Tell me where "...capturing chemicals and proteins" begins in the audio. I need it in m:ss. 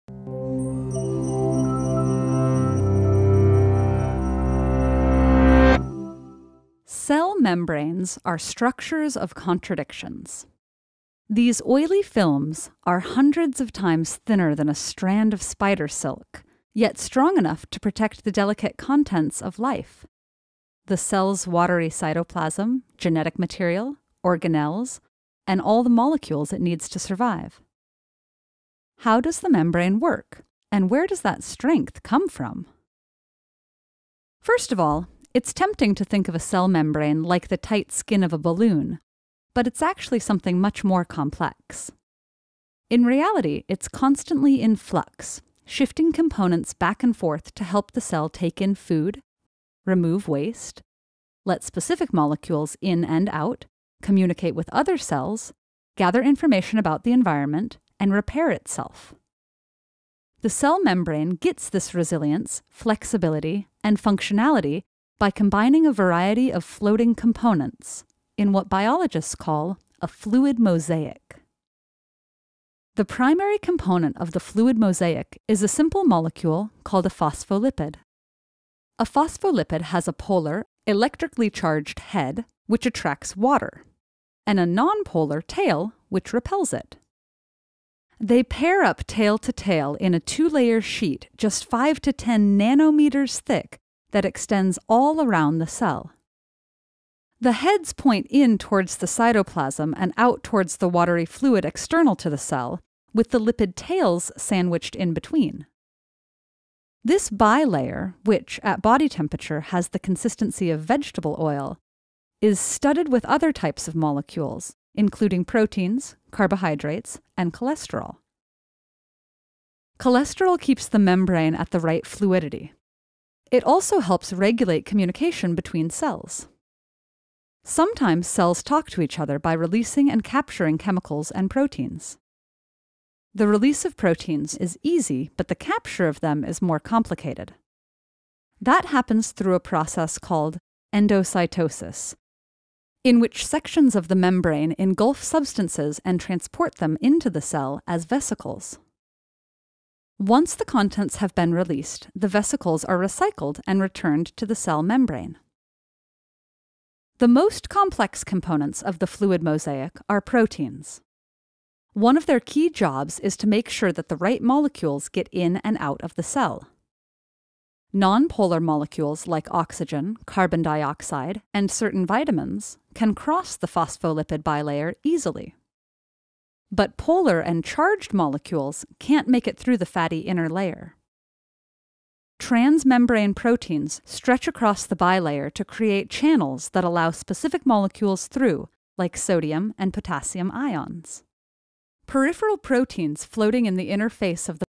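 2:10.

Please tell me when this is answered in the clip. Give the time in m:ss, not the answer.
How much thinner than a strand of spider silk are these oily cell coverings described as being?
0:12.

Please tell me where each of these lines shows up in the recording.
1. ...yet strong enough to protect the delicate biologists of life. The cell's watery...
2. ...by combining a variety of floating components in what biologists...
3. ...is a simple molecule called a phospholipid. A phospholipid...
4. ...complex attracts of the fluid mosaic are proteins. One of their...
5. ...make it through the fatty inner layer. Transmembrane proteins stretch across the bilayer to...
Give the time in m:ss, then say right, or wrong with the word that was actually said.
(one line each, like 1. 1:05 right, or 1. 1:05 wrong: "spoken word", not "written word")
1. 0:16 wrong: "contents", not "biologists"
2. 1:05 right
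3. 1:15 right
4. 2:37 wrong: "components", not "attracts"
5. 2:59 right.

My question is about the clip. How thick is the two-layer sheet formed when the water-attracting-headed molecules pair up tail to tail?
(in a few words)
5 to 10 nanometers.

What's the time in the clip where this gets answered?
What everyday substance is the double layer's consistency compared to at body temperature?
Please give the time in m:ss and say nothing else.
1:50.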